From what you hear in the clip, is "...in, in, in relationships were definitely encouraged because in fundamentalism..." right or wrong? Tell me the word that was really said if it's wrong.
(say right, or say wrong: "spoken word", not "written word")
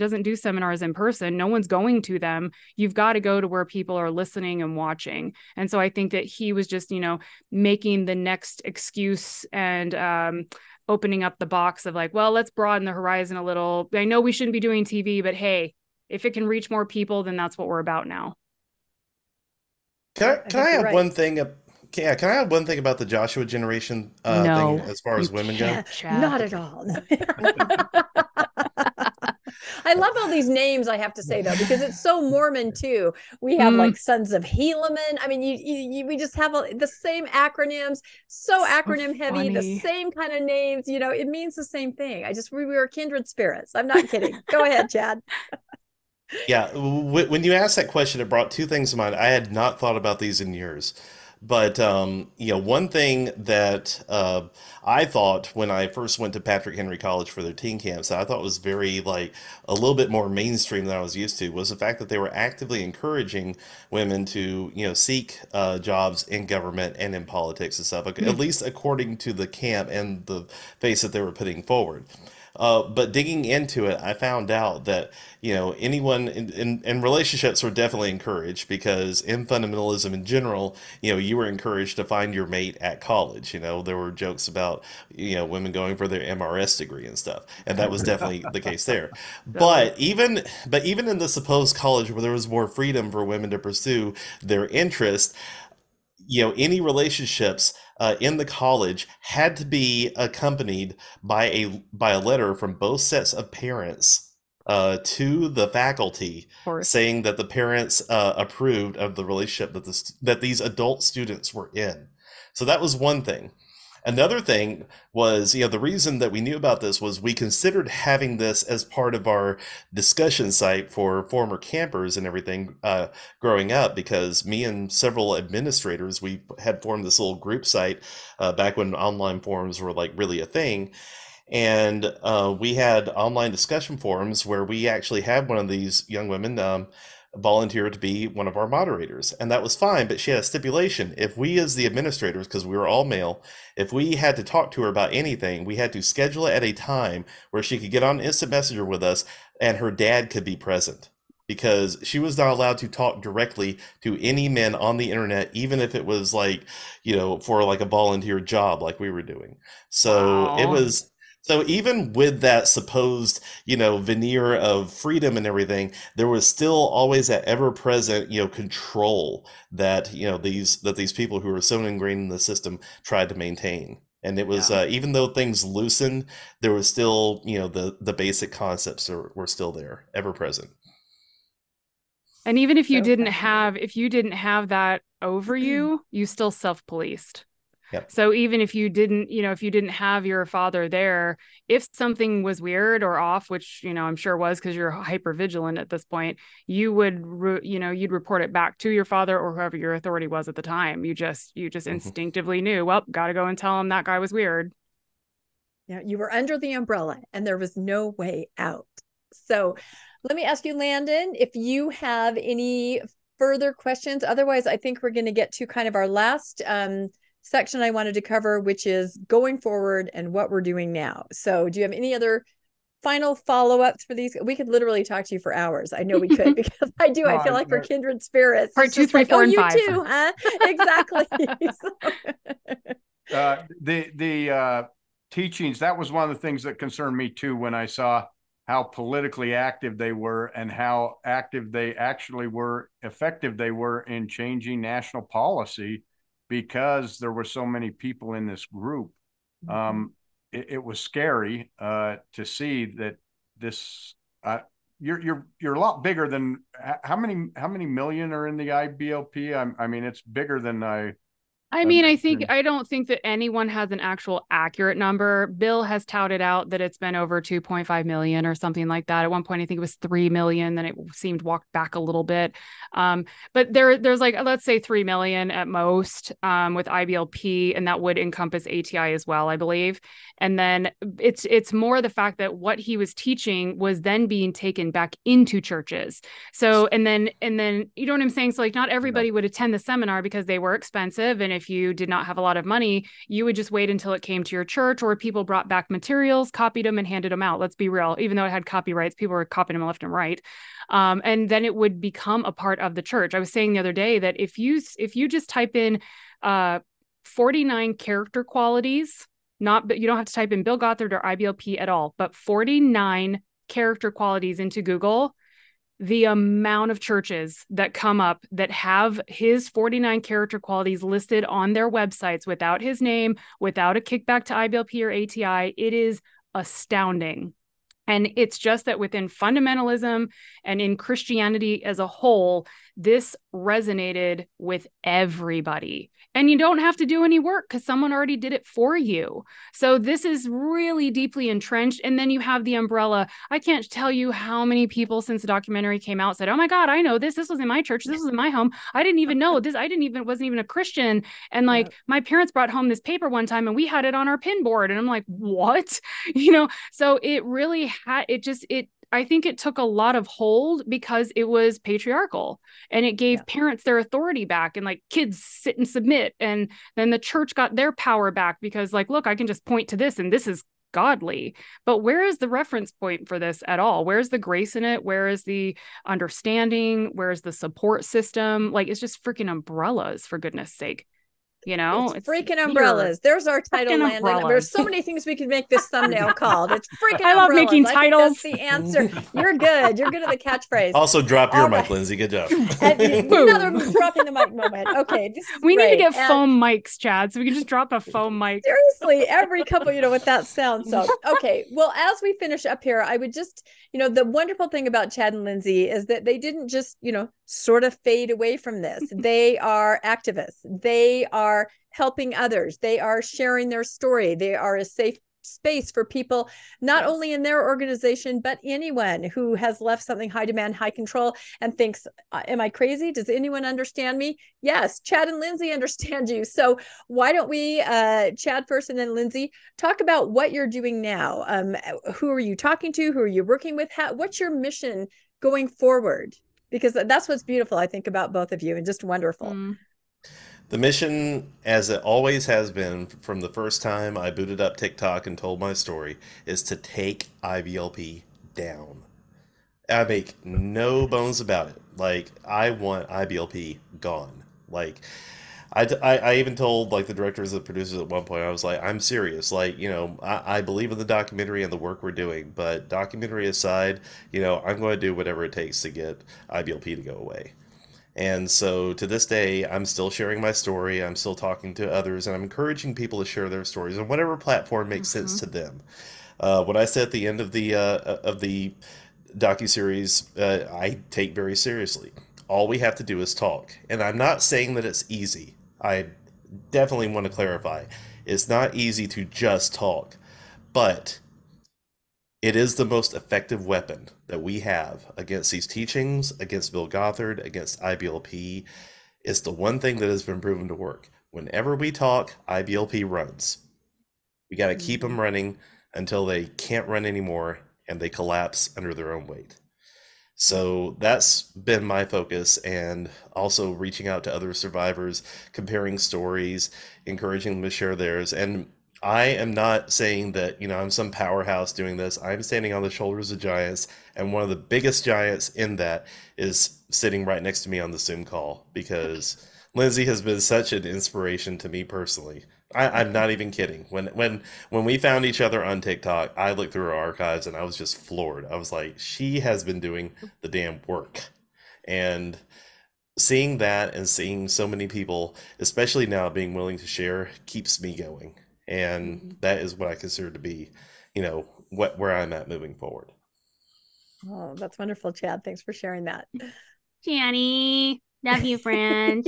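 right.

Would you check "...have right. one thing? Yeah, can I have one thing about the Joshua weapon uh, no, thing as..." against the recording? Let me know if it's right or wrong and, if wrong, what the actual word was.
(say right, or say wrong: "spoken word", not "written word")
wrong: "generation", not "weapon".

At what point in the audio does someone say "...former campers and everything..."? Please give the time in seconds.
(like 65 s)
121 s.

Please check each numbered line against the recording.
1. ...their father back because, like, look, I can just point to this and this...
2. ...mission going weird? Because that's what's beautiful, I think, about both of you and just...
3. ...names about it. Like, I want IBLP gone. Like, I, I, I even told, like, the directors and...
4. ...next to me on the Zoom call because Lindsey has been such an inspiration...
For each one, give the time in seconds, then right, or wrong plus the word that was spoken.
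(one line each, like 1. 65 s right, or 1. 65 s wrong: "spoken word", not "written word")
1. 367 s wrong: "power", not "father"
2. 434 s wrong: "forward", not "weird"
3. 451 s wrong: "bones", not "names"
4. 527 s right.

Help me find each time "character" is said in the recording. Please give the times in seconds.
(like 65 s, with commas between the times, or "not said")
307 s, 313 s, 320 s.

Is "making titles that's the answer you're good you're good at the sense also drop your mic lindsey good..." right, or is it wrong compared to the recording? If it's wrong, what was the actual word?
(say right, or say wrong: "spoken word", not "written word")
wrong: "catchphrase", not "sense".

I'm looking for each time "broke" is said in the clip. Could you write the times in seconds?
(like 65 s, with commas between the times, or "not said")
not said.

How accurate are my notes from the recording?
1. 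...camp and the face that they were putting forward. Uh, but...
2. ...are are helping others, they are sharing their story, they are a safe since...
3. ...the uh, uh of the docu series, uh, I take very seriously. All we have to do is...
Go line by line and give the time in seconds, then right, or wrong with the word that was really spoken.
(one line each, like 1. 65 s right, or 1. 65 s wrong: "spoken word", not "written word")
1. 69 s right
2. 411 s wrong: "space", not "since"
3. 477 s right.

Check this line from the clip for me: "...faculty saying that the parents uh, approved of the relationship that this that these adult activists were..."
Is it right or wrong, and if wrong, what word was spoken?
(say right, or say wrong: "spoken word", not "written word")
wrong: "students", not "activists".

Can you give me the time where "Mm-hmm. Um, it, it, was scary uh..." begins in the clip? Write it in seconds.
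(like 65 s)
249 s.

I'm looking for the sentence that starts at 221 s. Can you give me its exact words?
So, do you have any other final follow ups for these?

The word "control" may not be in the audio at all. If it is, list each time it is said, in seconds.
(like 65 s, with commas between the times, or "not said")
168 s, 420 s.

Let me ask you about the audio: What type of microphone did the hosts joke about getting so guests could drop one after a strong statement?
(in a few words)
foam mics.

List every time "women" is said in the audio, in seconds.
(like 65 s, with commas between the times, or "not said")
25 s, 63 s, 85 s, 93 s, 136 s.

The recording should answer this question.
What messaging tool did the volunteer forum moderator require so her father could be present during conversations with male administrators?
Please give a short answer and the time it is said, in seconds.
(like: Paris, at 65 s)
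instant messenger, at 148 s.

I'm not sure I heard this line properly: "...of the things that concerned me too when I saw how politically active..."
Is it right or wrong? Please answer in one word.
right.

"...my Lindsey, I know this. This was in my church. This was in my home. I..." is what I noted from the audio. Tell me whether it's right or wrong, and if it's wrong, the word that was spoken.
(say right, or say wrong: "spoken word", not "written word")
wrong: "God", not "Lindsey".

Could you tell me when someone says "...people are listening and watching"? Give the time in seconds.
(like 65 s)
3 s.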